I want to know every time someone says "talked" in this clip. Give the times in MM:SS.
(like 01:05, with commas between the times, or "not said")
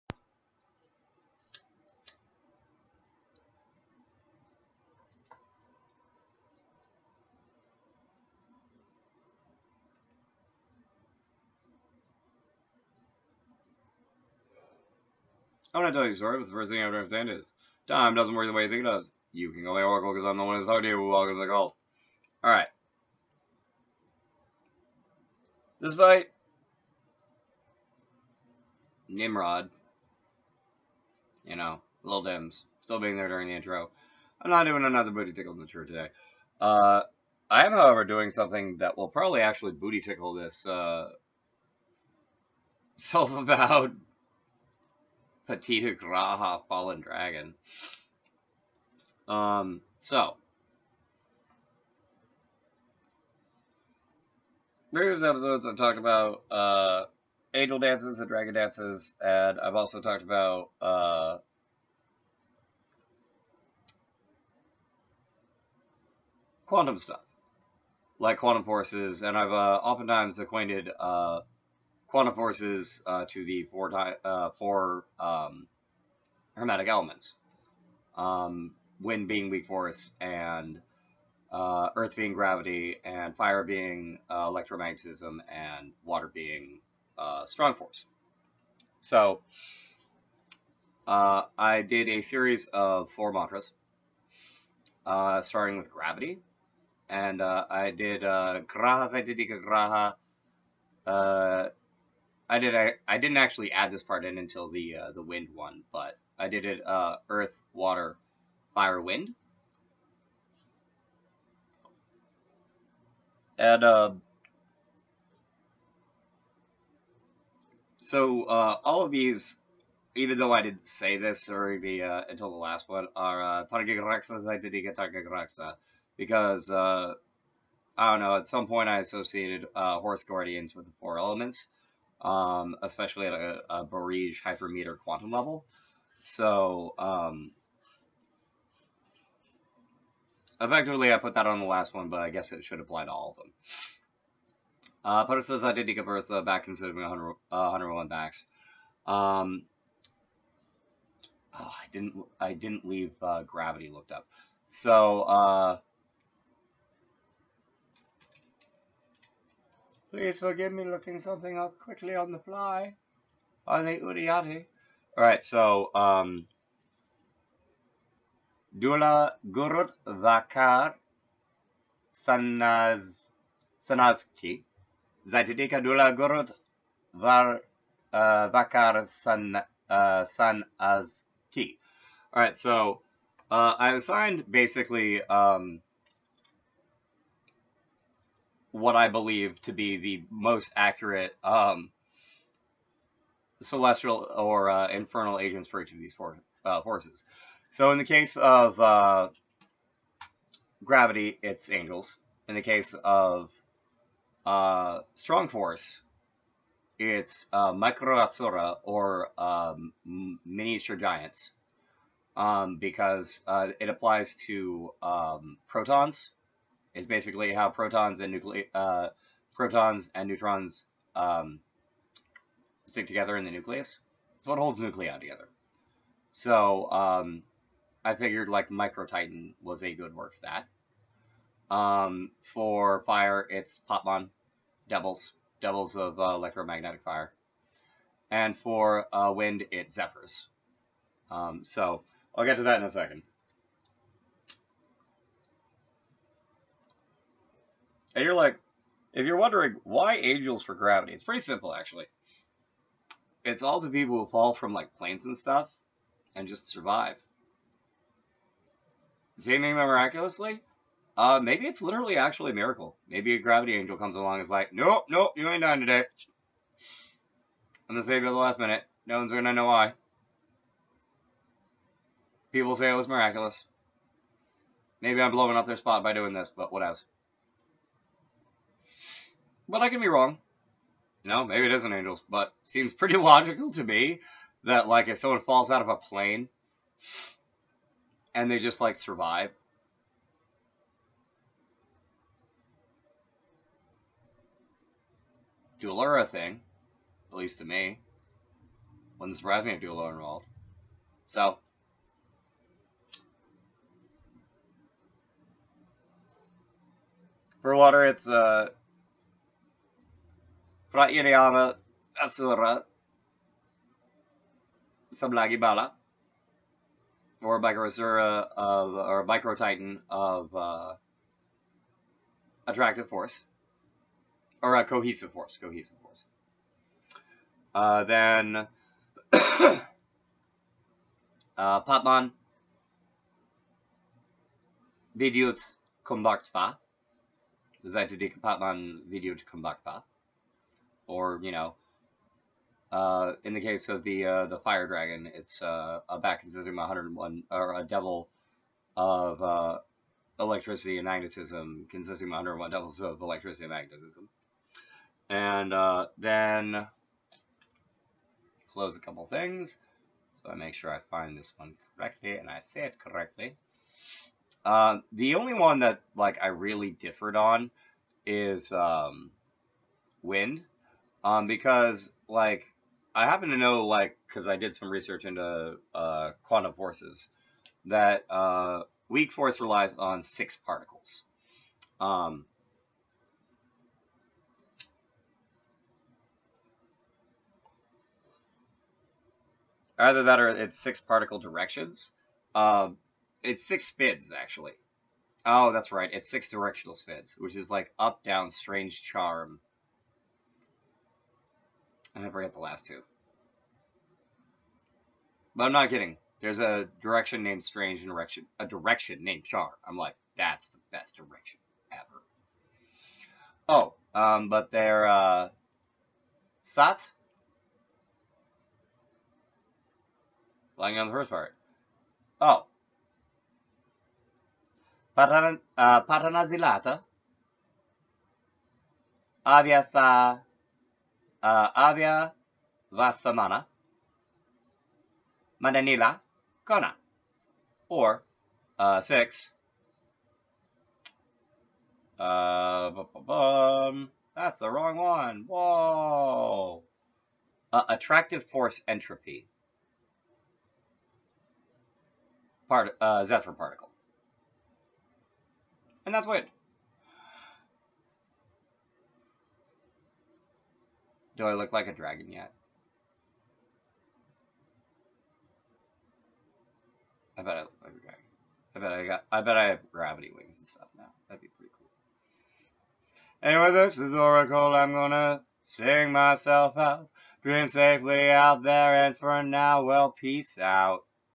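00:55, 01:00.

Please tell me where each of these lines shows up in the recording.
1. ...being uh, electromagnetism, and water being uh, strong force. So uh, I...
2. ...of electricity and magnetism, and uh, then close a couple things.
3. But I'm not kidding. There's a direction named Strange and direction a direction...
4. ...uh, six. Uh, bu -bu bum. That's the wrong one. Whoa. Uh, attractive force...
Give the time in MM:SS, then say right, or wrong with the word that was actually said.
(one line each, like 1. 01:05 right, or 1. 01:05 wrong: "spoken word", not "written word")
1. 01:23 right
2. 05:53 right
3. 06:45 right
4. 07:18 right.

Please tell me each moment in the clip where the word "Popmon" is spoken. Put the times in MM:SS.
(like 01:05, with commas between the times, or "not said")
03:53, 05:31, 05:39.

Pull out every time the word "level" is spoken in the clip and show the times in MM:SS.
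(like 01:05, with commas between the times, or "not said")
02:15.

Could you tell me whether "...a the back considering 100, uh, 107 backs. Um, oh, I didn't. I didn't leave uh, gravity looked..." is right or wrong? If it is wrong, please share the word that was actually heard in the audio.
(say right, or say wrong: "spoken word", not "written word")
wrong: "101", not "107".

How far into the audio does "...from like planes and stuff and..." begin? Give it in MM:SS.
04:14.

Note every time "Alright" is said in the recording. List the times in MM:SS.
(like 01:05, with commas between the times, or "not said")
00:22, 02:45, 03:02.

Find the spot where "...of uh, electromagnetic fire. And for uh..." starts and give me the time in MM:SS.
03:55.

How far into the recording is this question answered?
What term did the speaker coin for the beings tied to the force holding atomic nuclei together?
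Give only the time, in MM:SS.
03:48.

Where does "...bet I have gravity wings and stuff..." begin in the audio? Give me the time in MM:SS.
07:49.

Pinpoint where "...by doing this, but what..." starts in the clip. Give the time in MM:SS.
04:36.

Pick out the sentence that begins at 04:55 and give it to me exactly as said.
Dualura thing, at least to me.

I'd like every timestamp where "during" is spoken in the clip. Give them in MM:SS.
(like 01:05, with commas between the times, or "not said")
00:33.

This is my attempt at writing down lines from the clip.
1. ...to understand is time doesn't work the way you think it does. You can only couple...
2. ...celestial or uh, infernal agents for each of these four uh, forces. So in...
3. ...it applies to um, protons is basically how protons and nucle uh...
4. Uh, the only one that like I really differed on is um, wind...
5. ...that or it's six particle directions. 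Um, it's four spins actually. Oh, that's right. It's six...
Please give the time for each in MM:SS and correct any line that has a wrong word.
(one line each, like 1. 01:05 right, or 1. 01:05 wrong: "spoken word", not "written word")
1. 00:16 wrong: "oracle", not "couple"
2. 03:13 right
3. 03:33 right
4. 06:04 right
5. 06:30 wrong: "six", not "four".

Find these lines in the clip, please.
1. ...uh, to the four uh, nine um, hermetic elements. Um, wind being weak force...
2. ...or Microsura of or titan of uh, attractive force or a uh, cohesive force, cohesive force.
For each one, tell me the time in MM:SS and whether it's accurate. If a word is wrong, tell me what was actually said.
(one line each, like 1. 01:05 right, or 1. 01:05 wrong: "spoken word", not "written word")
1. 01:13 wrong: "four", not "nine"
2. 05:17 right.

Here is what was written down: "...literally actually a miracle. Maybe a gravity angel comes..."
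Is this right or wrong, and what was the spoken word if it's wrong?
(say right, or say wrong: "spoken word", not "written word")
right.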